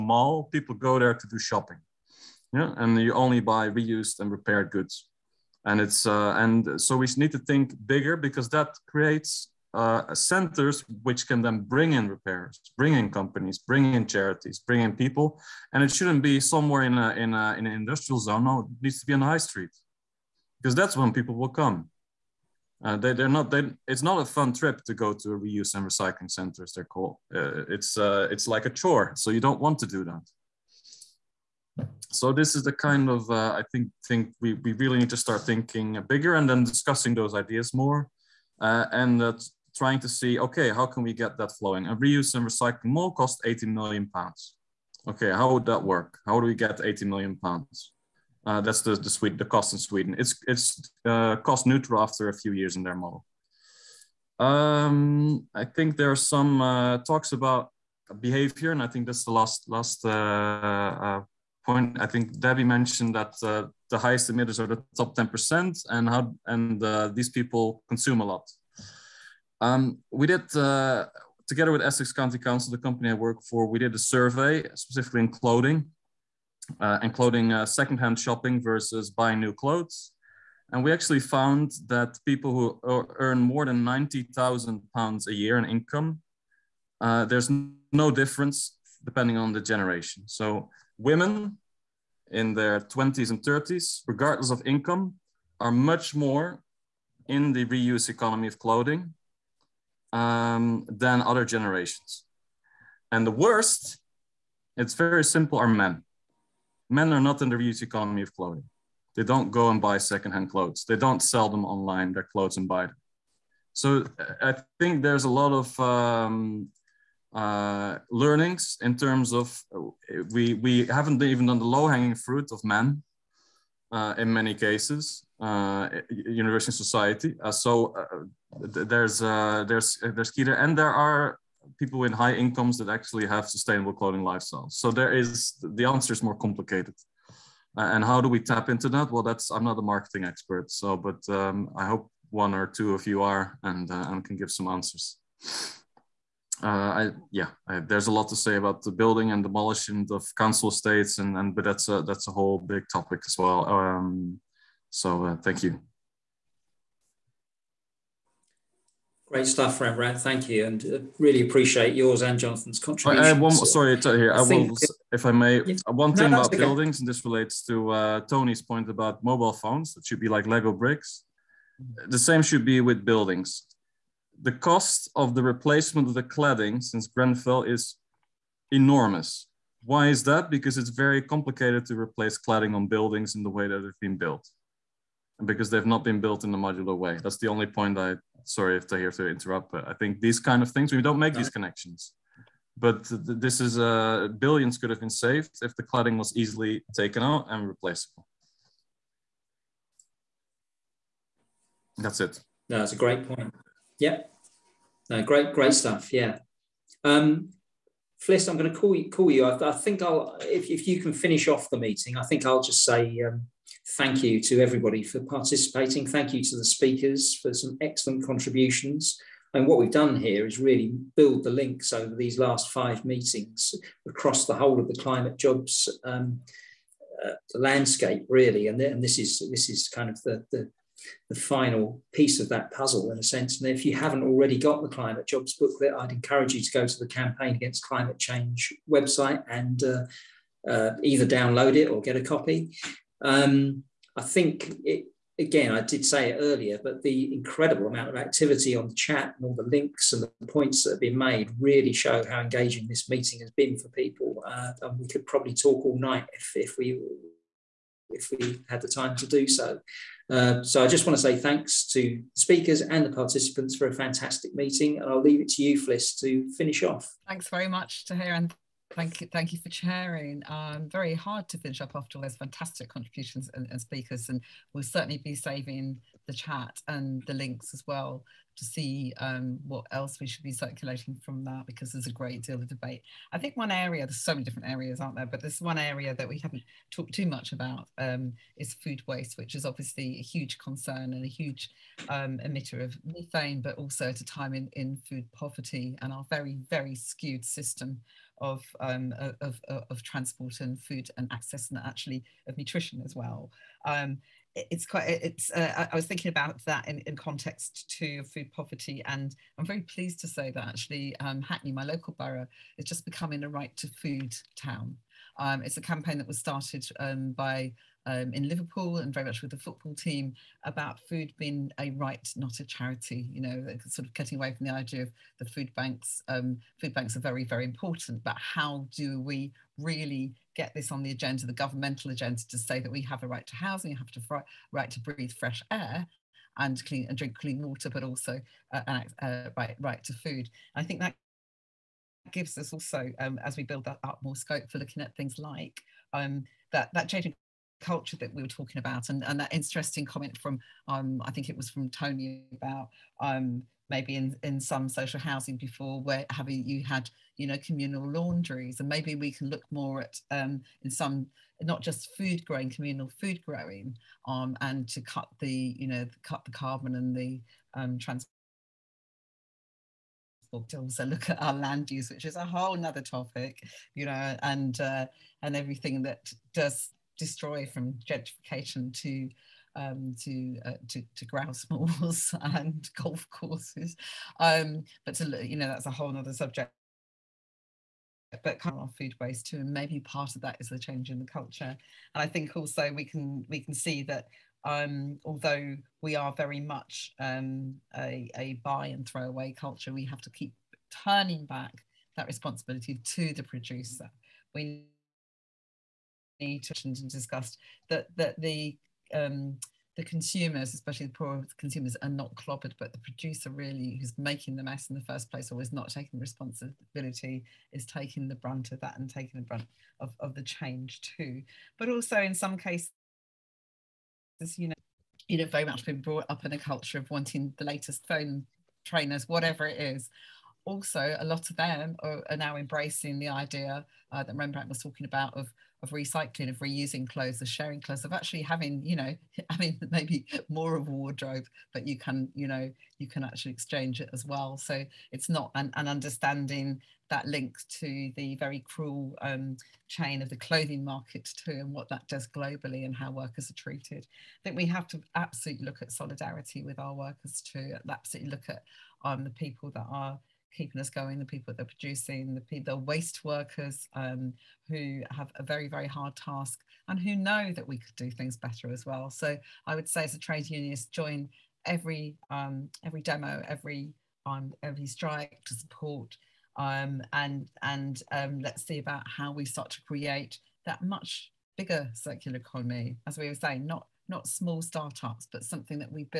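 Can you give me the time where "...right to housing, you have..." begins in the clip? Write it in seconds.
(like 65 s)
333 s.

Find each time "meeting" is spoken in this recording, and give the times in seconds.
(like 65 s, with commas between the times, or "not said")
211 s, 223 s, 253 s, 264 s.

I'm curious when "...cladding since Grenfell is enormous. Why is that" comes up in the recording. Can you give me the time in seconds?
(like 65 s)
176 s.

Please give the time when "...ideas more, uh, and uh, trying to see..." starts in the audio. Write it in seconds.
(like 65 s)
37 s.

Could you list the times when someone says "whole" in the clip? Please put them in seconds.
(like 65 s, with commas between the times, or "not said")
152 s, 224 s, 372 s, 385 s.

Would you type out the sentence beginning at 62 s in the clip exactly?
I think Debbie mentioned that uh, the highest emitters are the top ten percent, and how and these people consume a lot.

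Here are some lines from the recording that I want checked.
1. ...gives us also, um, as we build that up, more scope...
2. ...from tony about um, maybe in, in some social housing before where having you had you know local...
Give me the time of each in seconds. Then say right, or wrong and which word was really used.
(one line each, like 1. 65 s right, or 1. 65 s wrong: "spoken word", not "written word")
1. 342 s right
2. 351 s wrong: "communal", not "local".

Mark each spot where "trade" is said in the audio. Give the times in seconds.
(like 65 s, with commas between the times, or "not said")
470 s.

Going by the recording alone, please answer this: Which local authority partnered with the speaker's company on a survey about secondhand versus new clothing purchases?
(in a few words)
Essex County Council.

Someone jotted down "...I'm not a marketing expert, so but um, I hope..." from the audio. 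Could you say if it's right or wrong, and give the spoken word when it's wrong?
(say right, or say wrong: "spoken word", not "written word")
right.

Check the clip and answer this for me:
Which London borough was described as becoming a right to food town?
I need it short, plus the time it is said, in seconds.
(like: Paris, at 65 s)
Hackney, at 311 s.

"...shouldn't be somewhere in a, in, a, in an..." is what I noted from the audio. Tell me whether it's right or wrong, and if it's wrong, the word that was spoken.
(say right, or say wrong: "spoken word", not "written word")
right.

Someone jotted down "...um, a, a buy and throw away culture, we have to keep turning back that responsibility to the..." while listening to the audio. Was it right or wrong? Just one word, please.
right.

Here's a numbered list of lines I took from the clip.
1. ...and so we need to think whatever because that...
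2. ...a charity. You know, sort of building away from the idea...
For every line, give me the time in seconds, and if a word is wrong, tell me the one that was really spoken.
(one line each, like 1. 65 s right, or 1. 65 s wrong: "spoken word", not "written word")
1. 6 s wrong: "bigger", not "whatever"
2. 322 s wrong: "cutting", not "building".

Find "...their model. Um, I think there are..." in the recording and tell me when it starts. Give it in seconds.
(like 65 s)
52 s.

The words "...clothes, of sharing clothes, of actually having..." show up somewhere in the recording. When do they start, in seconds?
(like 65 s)
437 s.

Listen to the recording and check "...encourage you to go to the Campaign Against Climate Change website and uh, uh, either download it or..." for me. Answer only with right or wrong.
right.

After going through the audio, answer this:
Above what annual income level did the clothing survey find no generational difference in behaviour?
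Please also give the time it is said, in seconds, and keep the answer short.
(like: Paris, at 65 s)
90,000 pounds, at 83 s.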